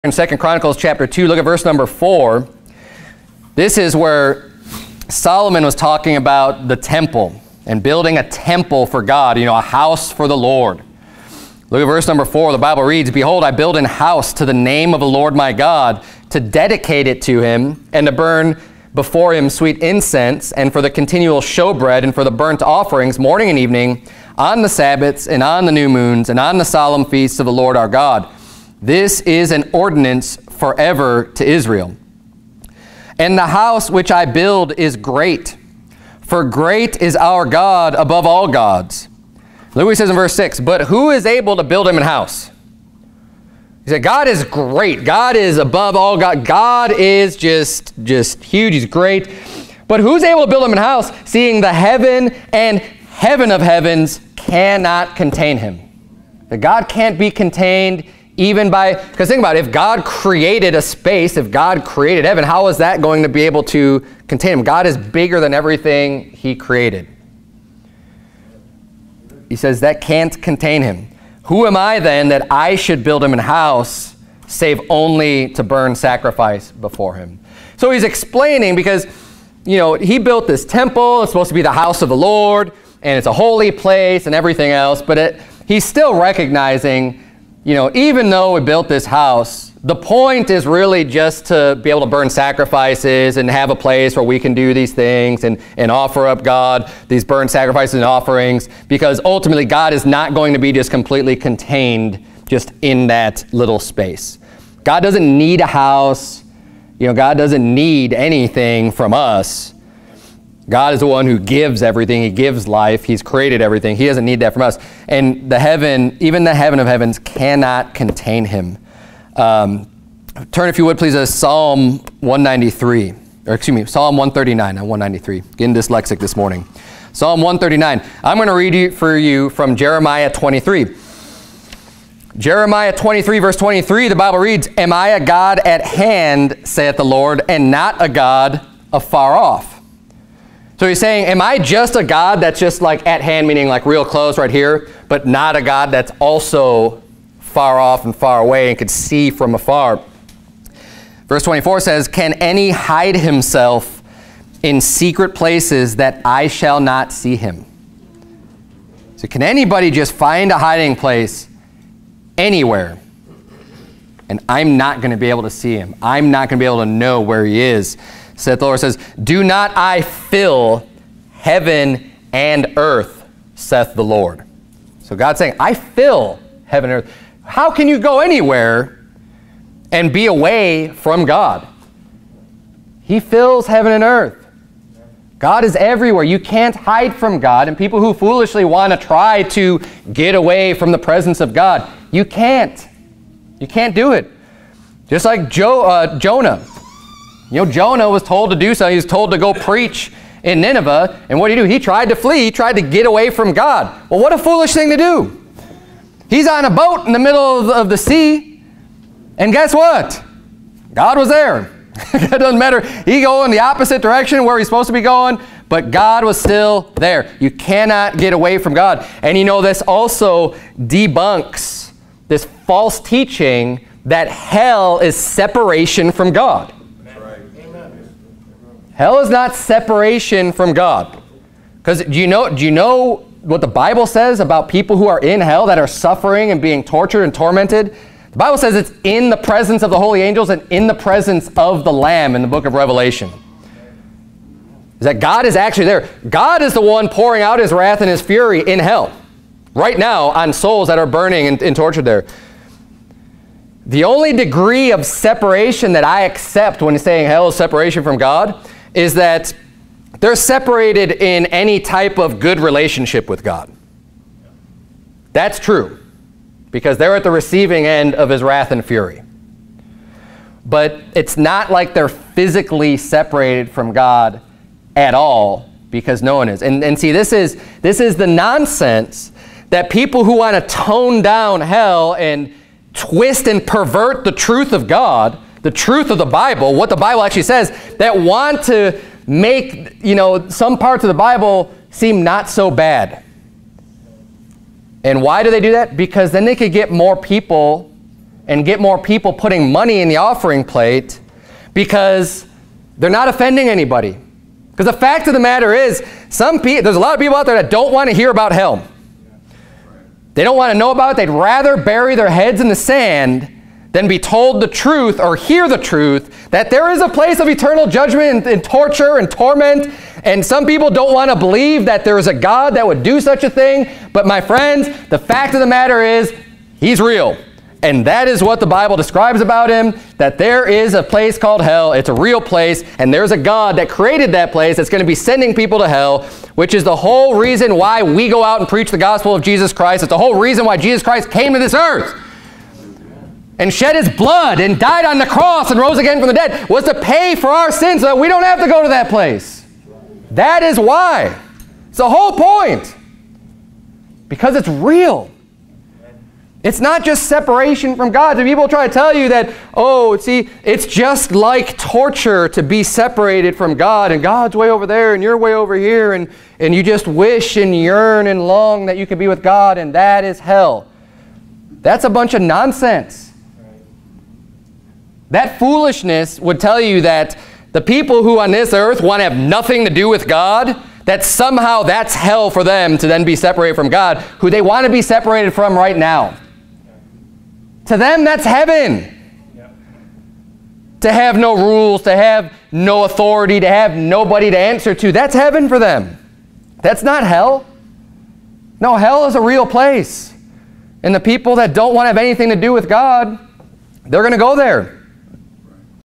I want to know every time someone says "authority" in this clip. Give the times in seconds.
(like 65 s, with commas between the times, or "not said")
393 s.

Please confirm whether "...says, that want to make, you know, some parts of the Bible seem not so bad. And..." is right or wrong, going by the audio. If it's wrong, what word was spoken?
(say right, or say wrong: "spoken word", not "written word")
right.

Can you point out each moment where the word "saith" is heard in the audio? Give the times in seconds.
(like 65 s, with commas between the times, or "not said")
136 s, 168 s, 173 s.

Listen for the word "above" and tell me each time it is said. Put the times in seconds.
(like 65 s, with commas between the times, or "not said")
37 s, 45 s.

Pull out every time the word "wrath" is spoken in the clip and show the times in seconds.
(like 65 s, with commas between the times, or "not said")
247 s, 268 s.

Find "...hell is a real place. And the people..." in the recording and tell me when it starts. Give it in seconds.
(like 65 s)
398 s.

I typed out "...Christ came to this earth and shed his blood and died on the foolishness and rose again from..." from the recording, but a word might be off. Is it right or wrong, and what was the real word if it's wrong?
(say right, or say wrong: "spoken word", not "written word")
wrong: "cross", not "foolishness".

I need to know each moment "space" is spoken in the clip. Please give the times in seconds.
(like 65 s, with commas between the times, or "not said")
60 s, 103 s.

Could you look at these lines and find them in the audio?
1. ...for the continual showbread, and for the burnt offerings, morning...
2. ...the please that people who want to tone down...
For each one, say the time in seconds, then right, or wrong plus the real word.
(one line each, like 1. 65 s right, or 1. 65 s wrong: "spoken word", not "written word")
1. 20 s right
2. 278 s wrong: "nonsense", not "please".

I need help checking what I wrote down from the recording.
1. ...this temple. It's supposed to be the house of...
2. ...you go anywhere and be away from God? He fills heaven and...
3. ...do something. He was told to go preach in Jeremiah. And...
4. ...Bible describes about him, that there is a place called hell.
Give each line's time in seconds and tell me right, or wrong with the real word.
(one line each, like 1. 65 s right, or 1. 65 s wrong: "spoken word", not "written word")
1. 80 s right
2. 177 s right
3. 198 s wrong: "Nineveh", not "Jeremiah"
4. 328 s right.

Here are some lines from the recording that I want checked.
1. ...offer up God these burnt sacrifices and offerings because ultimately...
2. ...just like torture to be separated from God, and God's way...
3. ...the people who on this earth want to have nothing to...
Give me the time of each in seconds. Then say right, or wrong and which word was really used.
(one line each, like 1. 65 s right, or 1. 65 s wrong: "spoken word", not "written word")
1. 95 s right
2. 360 s right
3. 377 s right.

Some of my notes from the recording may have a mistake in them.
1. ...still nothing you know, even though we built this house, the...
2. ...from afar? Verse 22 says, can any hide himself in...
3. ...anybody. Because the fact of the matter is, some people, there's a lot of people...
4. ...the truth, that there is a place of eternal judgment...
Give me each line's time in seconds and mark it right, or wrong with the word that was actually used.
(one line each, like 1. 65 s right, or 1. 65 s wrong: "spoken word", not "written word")
1. 85 s wrong: "recognizing", not "nothing"
2. 149 s wrong: "24", not "22"
3. 303 s right
4. 315 s right.